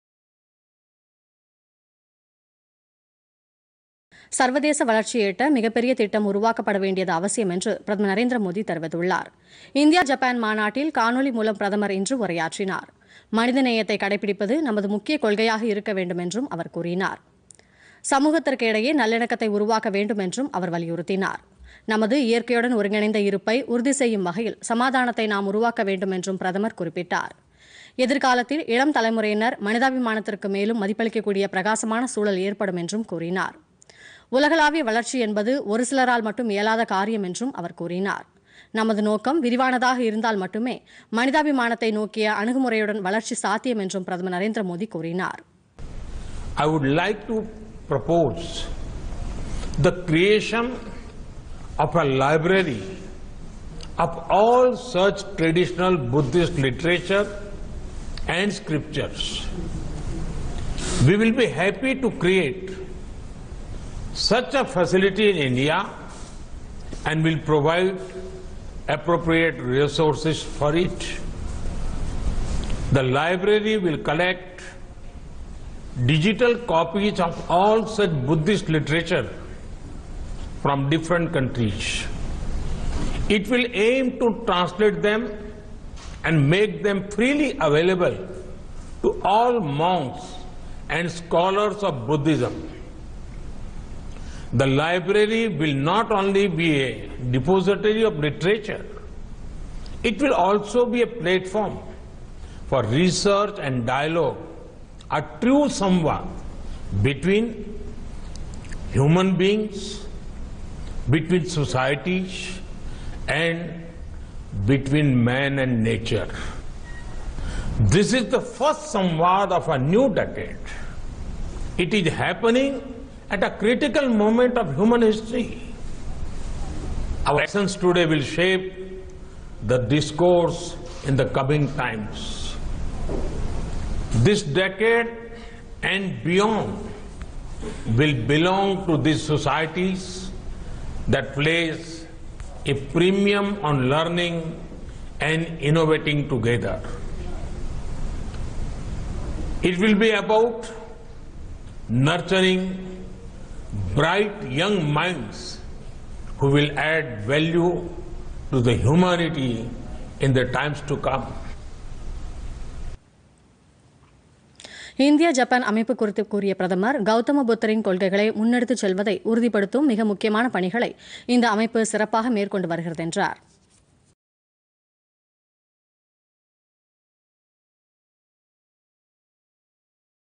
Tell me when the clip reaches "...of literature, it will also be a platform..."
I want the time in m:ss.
1:38.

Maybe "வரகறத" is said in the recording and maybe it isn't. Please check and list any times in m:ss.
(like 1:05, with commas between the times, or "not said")
2:52.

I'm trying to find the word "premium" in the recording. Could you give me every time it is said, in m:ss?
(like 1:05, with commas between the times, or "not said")
2:22.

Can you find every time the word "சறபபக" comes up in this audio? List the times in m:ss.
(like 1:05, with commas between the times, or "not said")
2:51.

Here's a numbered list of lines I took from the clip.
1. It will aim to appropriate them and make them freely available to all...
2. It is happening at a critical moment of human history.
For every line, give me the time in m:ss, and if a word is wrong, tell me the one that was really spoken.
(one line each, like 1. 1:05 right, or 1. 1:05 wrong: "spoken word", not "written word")
1. 1:23 wrong: "translate", not "appropriate"
2. 2:01 right.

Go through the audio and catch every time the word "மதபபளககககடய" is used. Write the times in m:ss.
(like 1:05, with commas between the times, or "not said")
0:30.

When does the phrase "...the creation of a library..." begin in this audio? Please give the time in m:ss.
0:49.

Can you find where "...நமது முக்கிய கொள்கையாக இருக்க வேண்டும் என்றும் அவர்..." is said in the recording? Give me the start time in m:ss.
0:14.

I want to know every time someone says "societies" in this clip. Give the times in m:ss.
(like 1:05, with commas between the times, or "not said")
1:51, 2:19.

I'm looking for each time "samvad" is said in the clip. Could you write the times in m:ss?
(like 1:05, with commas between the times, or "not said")
1:45, 1:58.